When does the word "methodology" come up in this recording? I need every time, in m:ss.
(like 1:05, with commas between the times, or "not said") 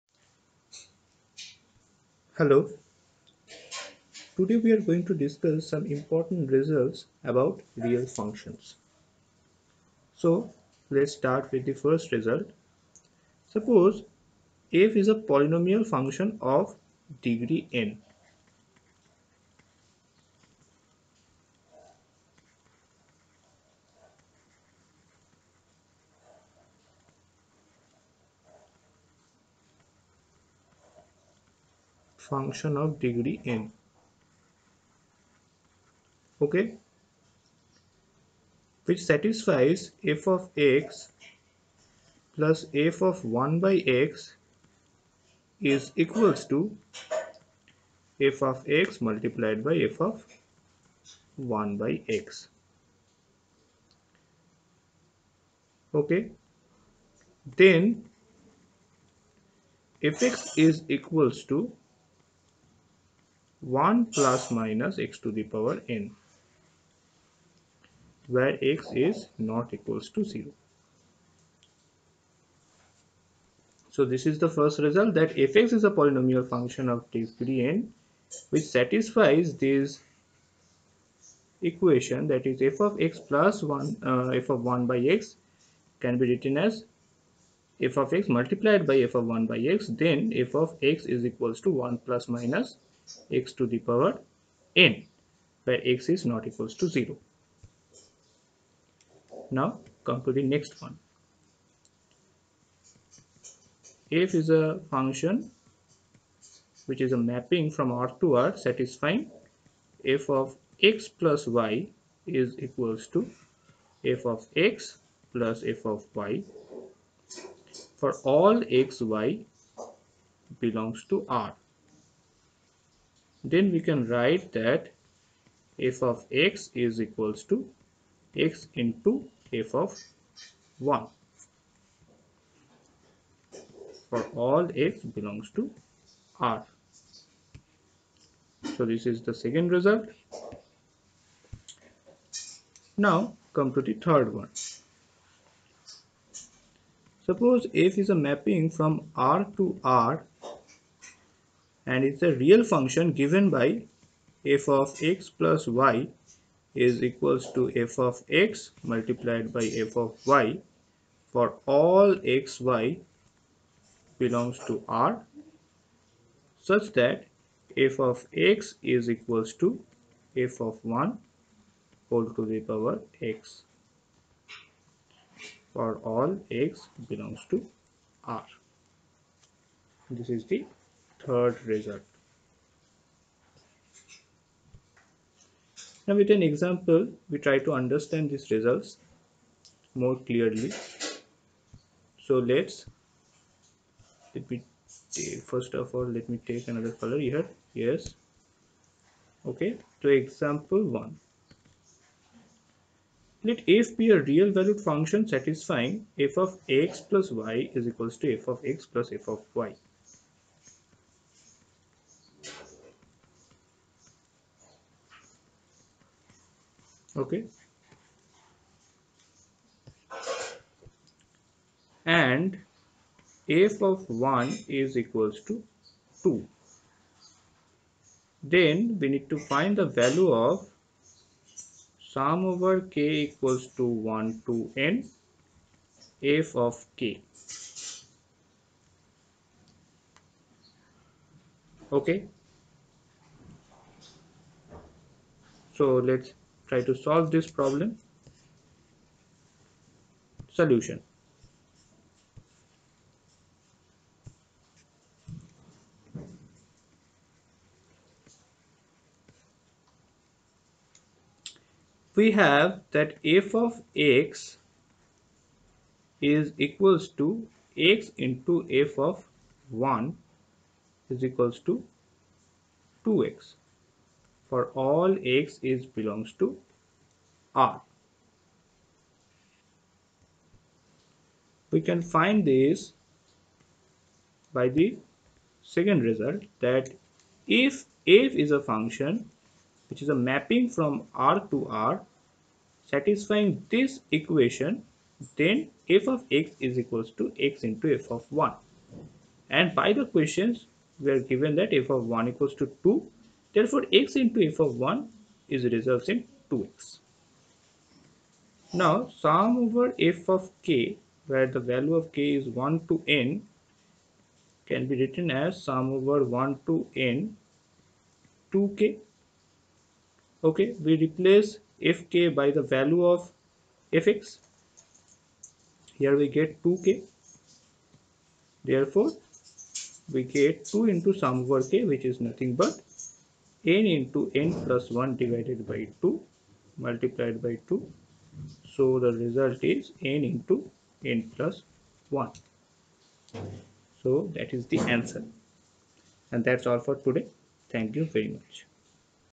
not said.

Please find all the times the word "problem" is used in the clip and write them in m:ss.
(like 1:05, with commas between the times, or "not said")
4:07.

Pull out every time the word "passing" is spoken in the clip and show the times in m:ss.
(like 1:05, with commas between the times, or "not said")
not said.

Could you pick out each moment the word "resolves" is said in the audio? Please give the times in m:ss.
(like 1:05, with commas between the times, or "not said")
5:05.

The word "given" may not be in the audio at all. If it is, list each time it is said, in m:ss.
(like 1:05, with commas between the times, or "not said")
2:33, 5:01.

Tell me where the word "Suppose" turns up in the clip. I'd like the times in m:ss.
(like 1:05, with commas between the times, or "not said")
0:13, 2:27.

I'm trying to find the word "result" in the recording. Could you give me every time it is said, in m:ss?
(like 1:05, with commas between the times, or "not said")
0:06, 0:12, 1:14, 2:19, 3:01, 3:08, 4:46, 5:39.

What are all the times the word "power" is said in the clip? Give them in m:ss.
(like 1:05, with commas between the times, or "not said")
1:05, 1:33, 2:52.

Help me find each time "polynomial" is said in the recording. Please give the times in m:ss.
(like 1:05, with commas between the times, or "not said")
0:15, 1:15.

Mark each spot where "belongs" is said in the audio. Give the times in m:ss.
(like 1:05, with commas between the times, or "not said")
2:00, 2:15, 2:44, 2:57, 4:35.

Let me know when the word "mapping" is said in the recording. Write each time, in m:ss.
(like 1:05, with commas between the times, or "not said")
1:47, 2:28, 4:50.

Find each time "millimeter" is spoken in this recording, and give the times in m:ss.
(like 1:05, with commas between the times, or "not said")
not said.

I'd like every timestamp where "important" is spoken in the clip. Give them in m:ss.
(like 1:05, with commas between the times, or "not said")
0:05.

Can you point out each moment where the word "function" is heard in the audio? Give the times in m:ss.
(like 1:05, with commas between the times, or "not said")
0:08, 0:15, 0:32, 1:16, 1:44, 2:32, 3:24, 4:48.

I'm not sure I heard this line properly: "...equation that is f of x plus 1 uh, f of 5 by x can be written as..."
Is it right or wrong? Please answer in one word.
wrong.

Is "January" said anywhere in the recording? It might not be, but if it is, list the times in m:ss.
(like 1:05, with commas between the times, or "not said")
not said.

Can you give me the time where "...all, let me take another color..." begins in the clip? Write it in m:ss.
3:15.